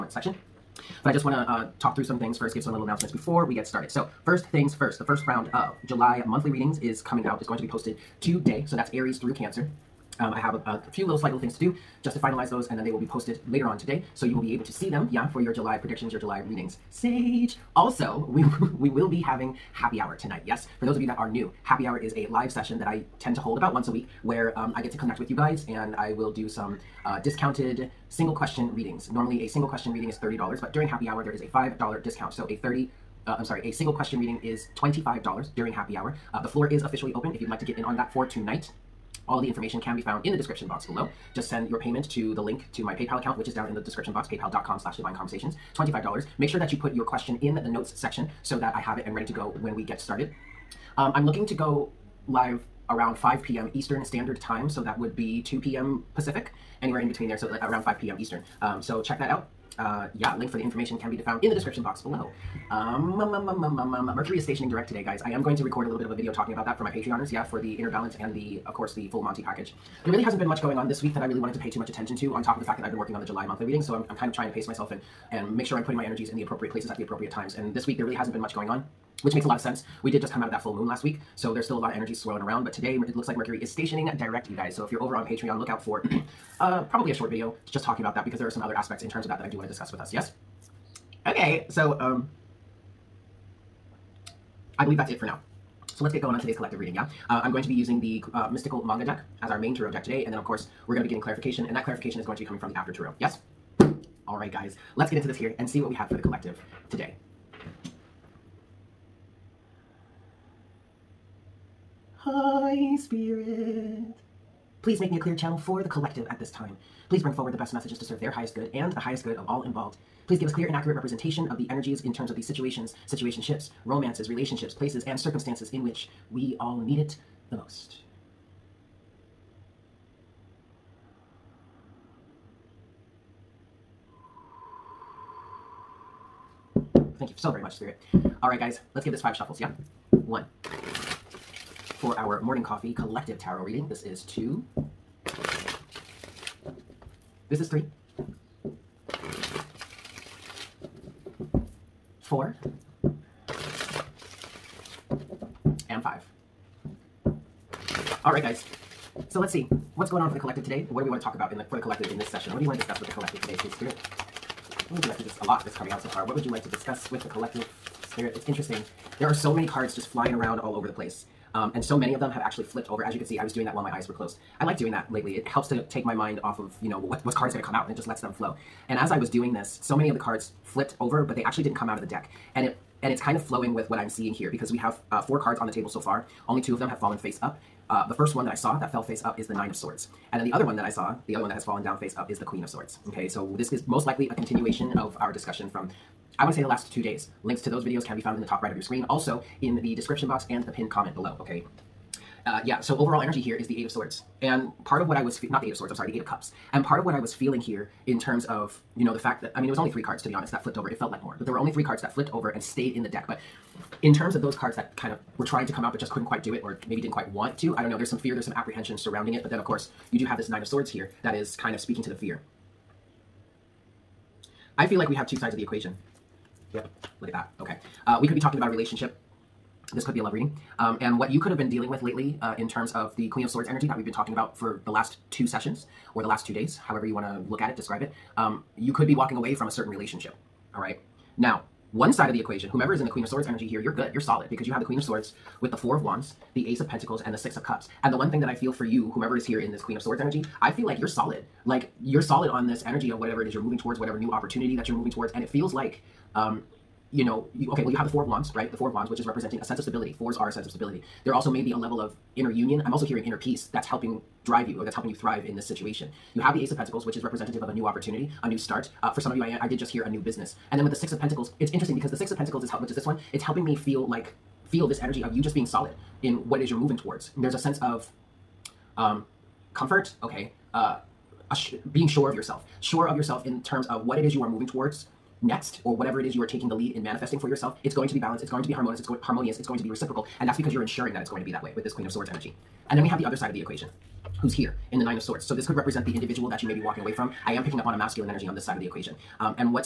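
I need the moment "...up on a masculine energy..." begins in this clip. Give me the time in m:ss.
4:57.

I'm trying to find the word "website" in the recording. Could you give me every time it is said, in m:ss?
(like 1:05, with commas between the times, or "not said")
not said.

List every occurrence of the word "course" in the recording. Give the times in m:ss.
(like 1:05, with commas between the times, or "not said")
1:08, 1:40, 3:39.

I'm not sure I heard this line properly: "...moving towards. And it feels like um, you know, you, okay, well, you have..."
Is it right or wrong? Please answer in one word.
right.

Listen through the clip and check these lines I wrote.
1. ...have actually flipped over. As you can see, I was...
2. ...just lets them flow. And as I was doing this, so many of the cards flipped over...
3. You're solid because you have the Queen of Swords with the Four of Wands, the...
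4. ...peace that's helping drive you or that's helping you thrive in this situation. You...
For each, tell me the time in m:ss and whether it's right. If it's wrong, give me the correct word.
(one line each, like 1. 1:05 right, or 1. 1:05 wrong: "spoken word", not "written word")
1. 2:52 right
2. 2:57 right
3. 4:04 right
4. 4:23 right.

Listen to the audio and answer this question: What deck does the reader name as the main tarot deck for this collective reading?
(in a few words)
Mystical Manga.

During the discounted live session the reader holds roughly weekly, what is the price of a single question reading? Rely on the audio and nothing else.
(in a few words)
$25.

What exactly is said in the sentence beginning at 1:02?
Um, um, um, Mercury is stationing direct today, guys.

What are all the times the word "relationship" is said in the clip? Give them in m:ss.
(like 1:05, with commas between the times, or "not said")
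2:04, 3:48, 3:59.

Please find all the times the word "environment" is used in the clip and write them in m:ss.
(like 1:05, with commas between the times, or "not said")
not said.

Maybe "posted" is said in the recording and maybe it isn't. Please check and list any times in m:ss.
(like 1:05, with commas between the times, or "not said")
0:07, 0:13.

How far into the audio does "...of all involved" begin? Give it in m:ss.
1:59.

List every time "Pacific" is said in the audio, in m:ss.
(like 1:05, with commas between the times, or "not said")
0:56.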